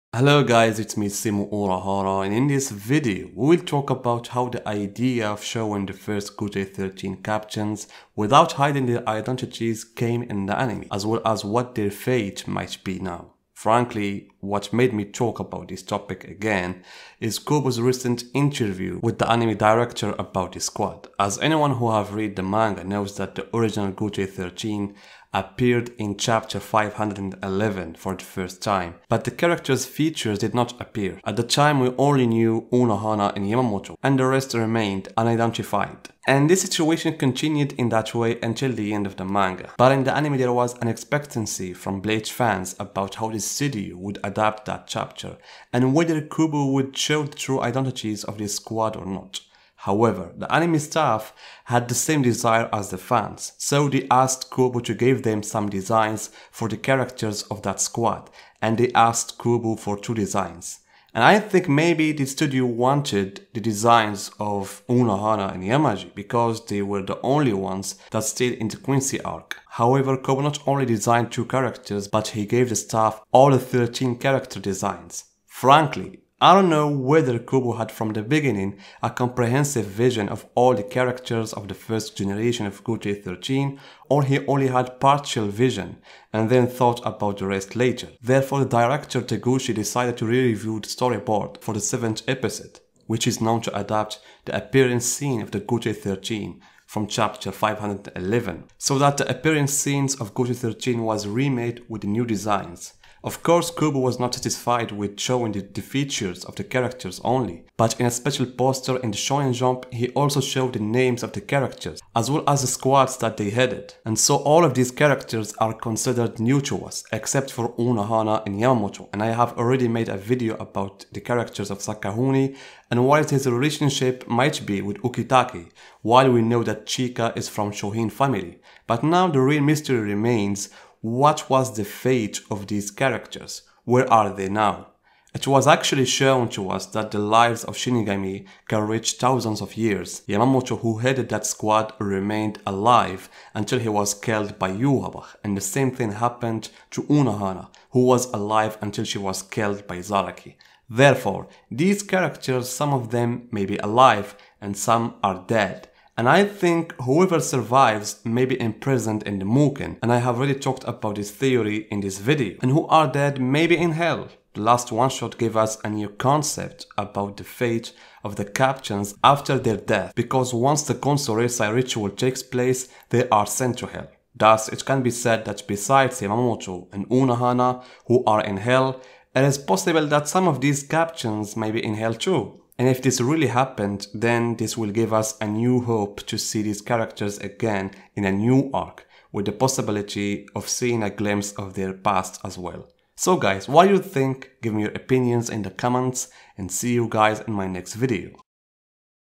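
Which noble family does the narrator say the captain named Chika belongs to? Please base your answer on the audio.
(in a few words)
Shihoin.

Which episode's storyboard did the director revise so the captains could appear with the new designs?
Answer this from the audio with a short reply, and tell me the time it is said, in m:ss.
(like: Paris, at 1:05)
7th episode, at 1:31.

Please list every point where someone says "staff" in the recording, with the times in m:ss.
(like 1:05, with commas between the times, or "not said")
0:50, 1:12.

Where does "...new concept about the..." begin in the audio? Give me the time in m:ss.
2:45.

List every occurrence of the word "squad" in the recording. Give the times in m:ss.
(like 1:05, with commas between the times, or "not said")
0:20, 0:48, 0:57, 1:52, 2:21.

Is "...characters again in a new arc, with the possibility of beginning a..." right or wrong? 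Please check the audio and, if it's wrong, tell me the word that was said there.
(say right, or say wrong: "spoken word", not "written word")
wrong: "seeing", not "beginning".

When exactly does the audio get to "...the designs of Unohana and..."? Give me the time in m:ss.
1:03.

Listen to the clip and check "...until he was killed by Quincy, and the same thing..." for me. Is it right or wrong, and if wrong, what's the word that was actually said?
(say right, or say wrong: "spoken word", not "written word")
wrong: "Yhwach", not "Quincy".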